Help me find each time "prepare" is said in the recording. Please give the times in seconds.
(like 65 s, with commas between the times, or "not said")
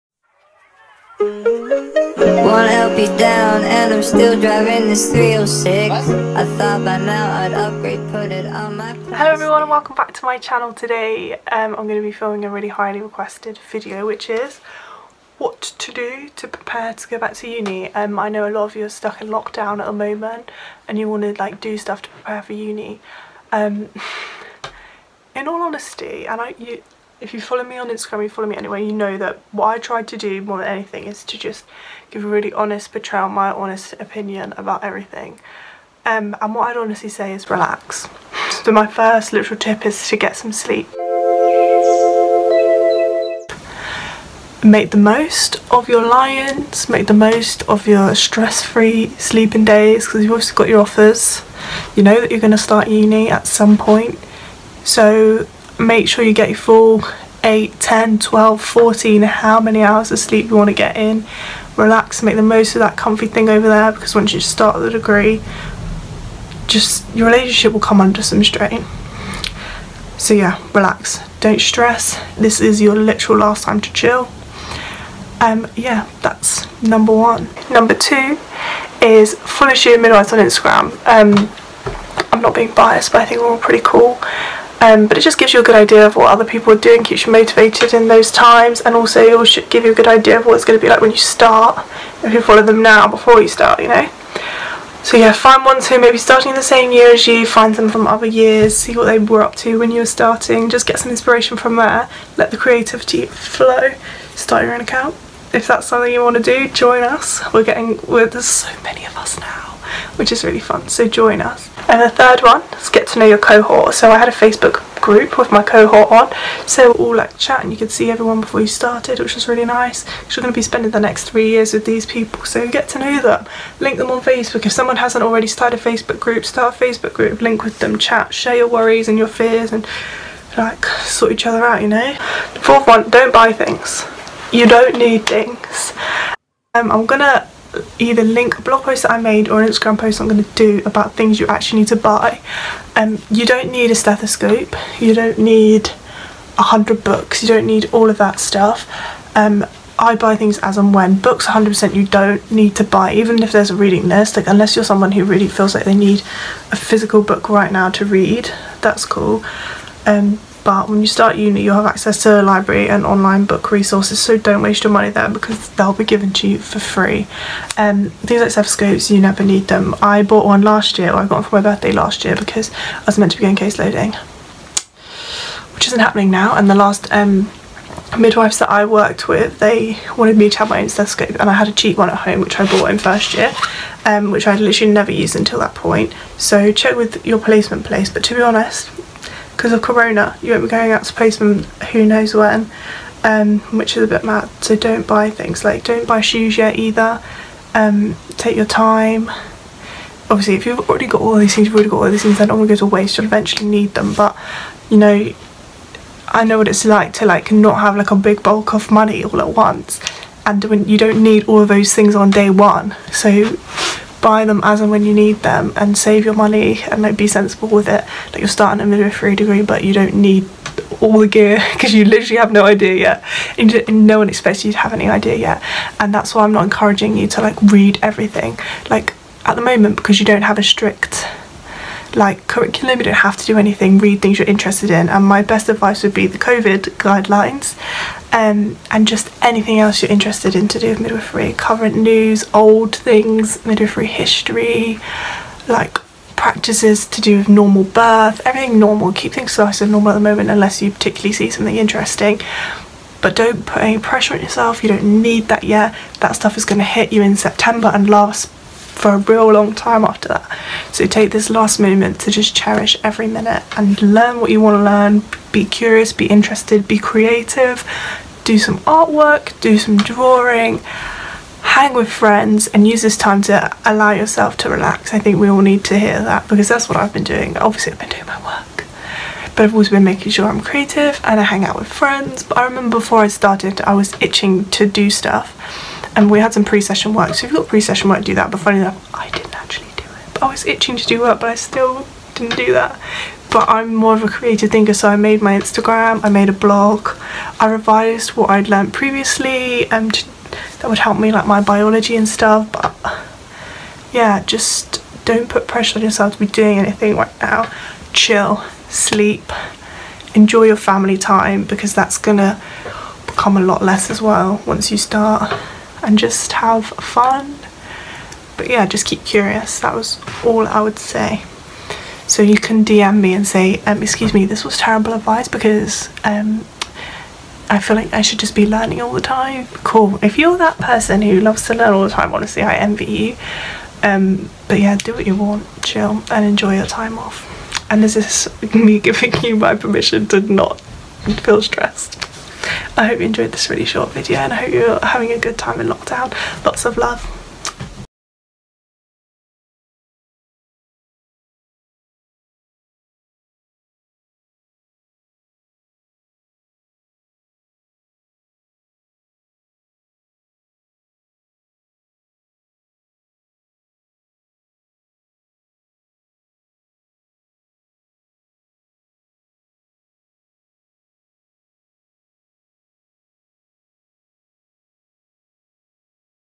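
16 s, 22 s.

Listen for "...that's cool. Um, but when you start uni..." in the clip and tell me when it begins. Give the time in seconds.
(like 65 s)
158 s.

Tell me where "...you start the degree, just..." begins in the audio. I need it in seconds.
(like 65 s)
64 s.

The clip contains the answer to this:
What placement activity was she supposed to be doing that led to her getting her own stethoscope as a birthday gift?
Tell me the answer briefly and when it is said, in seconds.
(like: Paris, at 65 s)
case loading, at 173 s.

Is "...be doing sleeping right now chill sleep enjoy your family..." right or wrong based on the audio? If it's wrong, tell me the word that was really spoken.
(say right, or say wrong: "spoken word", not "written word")
wrong: "anything", not "sleeping".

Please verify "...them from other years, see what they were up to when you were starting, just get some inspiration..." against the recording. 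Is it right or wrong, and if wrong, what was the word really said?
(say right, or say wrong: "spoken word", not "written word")
right.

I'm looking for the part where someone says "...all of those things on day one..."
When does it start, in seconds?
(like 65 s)
211 s.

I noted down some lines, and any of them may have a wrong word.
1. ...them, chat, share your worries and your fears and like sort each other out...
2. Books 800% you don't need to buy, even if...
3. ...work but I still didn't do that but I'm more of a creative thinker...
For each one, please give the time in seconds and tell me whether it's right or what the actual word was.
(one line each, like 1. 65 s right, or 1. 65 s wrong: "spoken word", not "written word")
1. 127 s right
2. 151 s wrong: "100", not "800"
3. 291 s right.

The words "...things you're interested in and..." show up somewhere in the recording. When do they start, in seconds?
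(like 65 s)
234 s.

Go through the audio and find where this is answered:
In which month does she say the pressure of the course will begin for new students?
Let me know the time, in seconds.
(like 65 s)
257 s.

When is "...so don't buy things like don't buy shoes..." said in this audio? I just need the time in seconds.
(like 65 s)
194 s.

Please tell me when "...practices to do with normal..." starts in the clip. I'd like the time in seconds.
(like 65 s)
246 s.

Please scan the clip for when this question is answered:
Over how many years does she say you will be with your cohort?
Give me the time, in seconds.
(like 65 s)
121 s.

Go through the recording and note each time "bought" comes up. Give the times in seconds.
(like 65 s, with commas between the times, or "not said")
170 s, 182 s.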